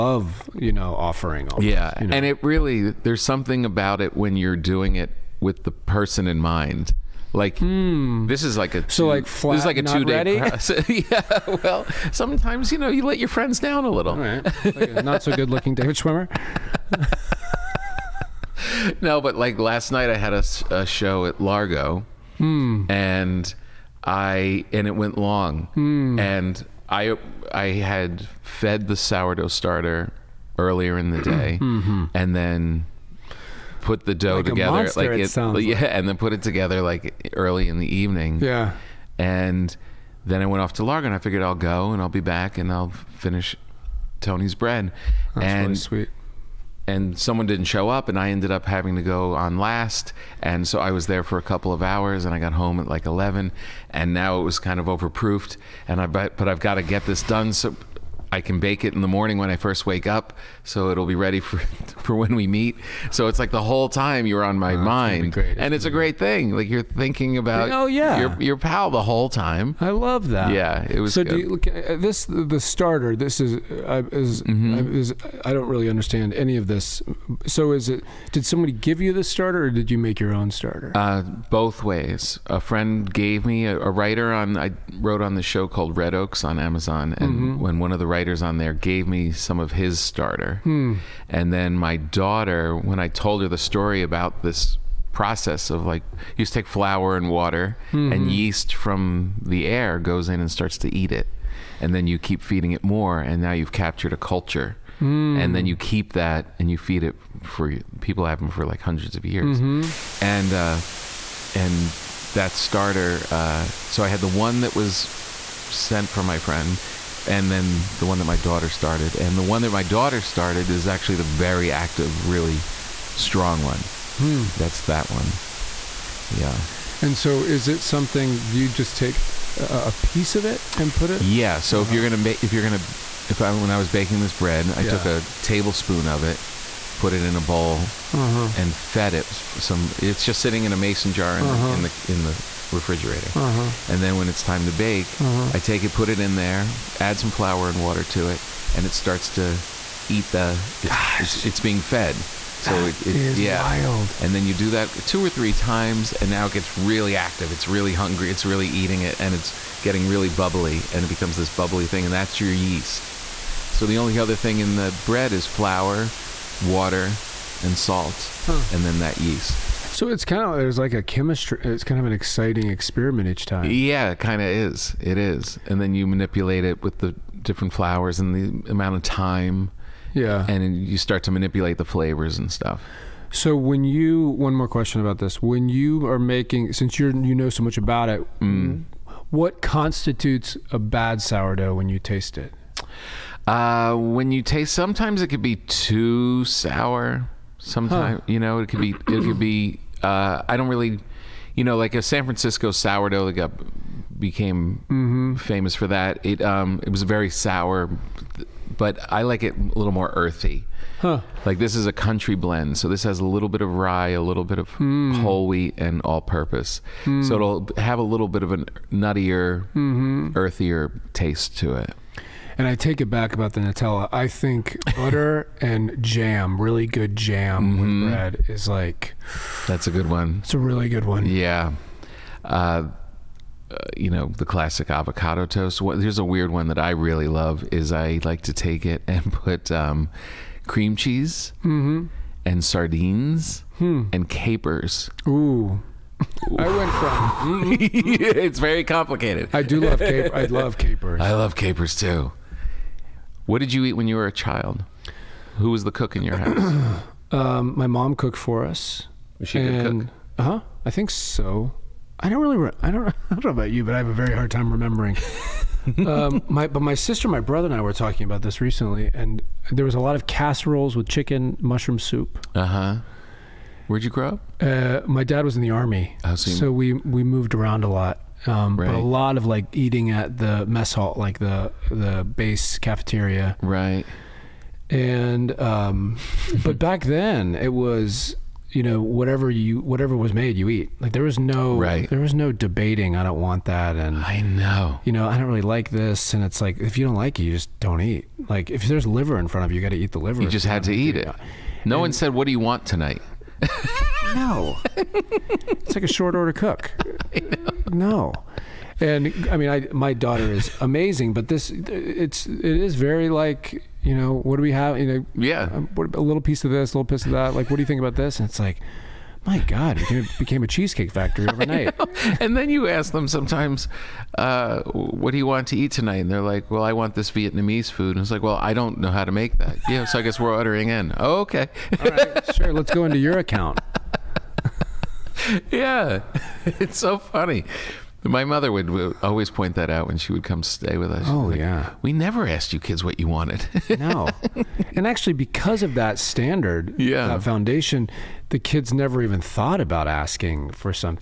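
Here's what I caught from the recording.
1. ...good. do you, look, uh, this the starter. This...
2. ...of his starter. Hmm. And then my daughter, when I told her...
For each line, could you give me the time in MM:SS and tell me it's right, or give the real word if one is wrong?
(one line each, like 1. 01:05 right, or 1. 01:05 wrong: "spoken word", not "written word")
1. 01:11 right
2. 01:29 right.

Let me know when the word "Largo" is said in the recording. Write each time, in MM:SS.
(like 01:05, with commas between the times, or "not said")
00:21, 00:40.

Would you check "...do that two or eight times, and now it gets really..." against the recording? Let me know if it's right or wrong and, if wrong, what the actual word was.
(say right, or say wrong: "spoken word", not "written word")
wrong: "three", not "eight".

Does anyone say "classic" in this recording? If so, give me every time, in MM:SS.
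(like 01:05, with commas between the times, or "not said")
03:54.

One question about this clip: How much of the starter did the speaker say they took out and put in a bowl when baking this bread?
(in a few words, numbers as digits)
a tablespoon.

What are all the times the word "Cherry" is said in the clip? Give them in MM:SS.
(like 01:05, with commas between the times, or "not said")
not said.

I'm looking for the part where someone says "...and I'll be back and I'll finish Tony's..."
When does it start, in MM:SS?
00:41.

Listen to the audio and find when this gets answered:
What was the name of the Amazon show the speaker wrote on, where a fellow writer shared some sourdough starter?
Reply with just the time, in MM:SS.
01:25.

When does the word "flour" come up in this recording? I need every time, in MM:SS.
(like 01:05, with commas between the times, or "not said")
01:36, 02:27, 02:45.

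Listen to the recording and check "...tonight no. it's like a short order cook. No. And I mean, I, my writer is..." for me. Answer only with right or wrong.
wrong.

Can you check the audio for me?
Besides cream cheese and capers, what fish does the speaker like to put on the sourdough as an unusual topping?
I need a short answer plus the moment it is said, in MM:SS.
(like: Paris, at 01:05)
sardines, at 04:02.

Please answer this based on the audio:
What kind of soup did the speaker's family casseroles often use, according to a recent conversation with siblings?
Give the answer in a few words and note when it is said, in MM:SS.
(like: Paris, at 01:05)
chicken mushroom soup, at 04:31.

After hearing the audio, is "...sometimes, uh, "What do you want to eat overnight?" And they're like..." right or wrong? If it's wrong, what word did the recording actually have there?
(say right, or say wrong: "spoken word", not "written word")
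wrong: "tonight", not "overnight".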